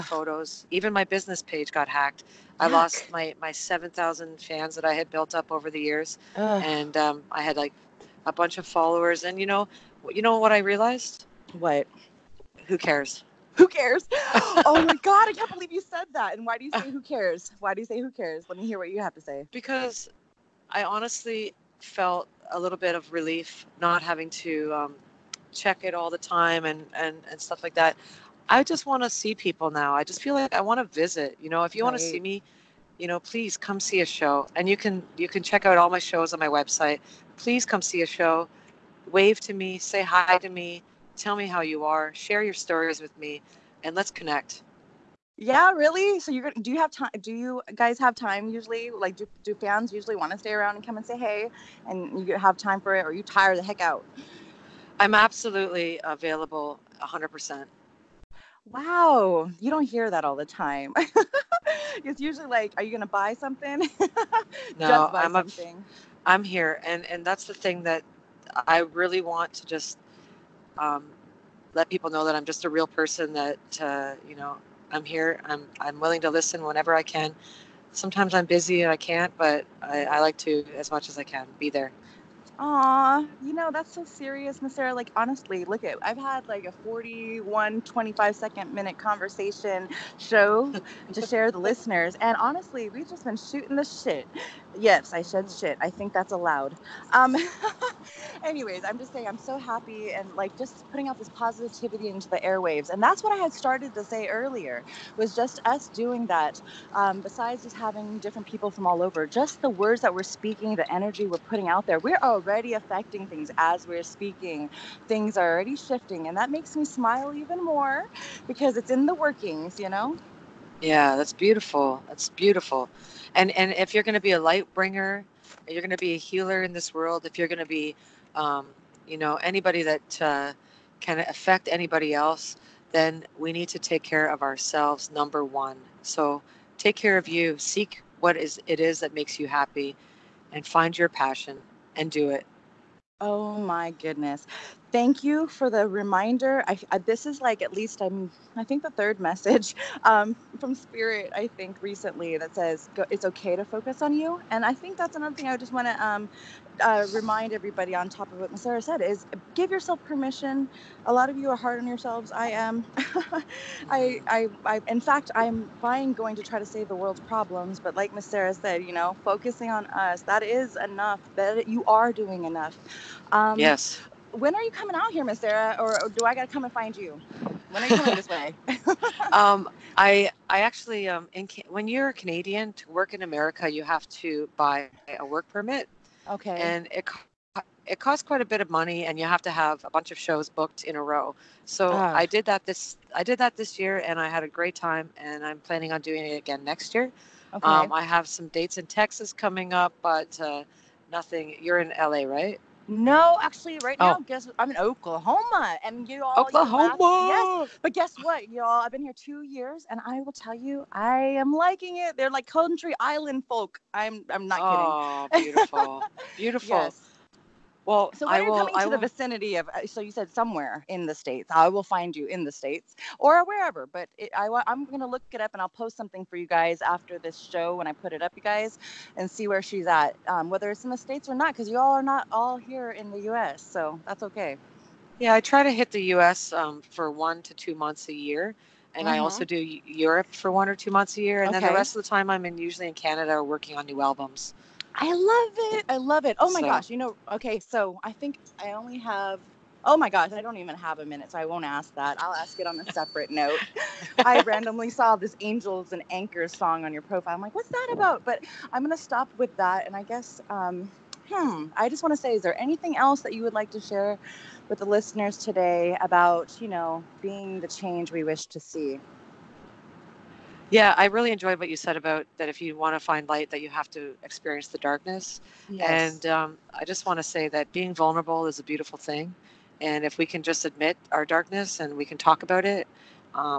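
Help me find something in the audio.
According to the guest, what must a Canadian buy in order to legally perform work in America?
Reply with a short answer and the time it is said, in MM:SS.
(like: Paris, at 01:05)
Work permit, at 03:05.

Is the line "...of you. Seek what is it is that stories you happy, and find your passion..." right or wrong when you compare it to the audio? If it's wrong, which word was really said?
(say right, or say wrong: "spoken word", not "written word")
wrong: "makes", not "stories".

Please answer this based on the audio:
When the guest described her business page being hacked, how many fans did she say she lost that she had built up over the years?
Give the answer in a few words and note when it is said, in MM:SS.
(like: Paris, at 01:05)
7000, at 00:03.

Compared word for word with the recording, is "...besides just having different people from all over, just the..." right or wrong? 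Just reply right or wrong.
right.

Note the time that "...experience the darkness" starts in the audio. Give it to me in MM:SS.
04:34.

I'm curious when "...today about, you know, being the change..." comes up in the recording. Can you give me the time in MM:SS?
04:25.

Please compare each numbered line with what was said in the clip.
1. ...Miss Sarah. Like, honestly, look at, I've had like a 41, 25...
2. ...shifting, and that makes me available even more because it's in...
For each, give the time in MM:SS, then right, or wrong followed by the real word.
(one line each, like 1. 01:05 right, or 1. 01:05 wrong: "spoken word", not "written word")
1. 01:24 right
2. 01:55 wrong: "smile", not "available".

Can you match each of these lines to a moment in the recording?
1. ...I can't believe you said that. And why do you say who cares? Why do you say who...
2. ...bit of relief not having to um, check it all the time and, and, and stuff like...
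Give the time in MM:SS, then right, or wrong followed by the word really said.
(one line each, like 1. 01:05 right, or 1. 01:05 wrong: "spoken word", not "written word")
1. 00:15 right
2. 00:22 right.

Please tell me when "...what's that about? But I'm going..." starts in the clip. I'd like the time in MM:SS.
04:17.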